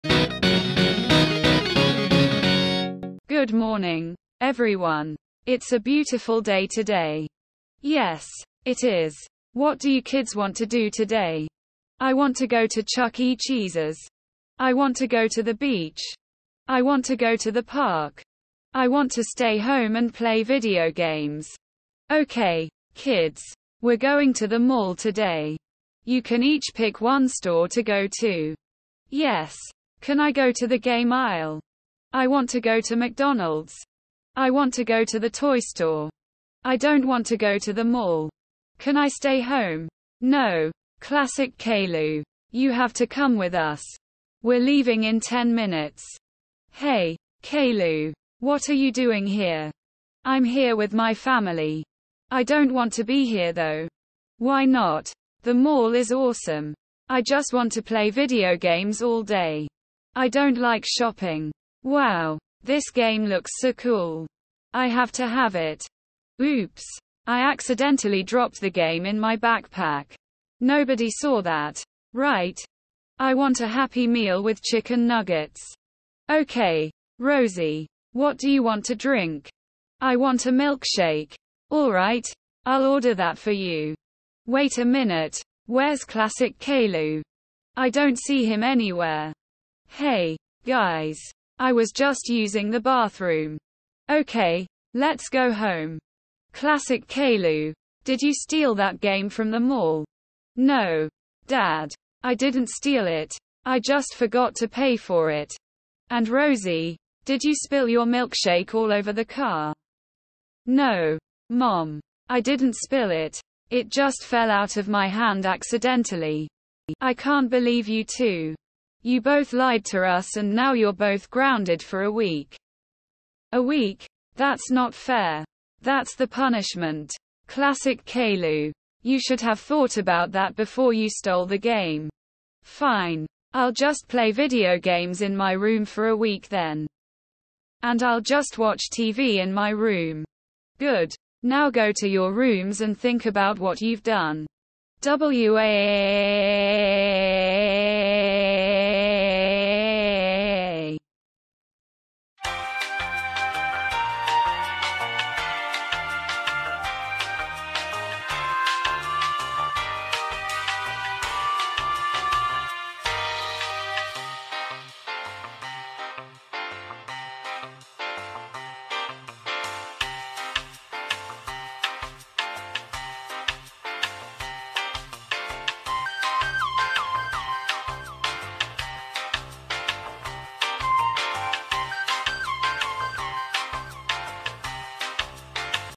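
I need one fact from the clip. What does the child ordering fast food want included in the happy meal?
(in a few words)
Chicken nuggets.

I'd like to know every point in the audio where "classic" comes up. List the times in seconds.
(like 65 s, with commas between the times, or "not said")
40 s, 86 s, 96 s, 127 s.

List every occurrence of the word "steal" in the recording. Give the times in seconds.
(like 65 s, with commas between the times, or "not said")
98 s, 102 s.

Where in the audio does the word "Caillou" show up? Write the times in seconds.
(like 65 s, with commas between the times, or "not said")
41 s, 47 s, 86 s, 97 s, 128 s.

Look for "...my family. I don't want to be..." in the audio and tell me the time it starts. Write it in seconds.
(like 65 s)
50 s.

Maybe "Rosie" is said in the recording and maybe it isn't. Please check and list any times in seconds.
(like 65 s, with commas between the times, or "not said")
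77 s, 106 s.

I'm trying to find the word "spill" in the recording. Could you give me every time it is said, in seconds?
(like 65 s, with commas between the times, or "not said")
107 s, 112 s.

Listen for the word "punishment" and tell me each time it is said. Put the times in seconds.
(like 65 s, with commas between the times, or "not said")
126 s.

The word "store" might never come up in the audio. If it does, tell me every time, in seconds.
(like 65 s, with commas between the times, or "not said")
27 s, 35 s.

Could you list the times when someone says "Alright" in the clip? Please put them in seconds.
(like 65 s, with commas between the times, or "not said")
81 s.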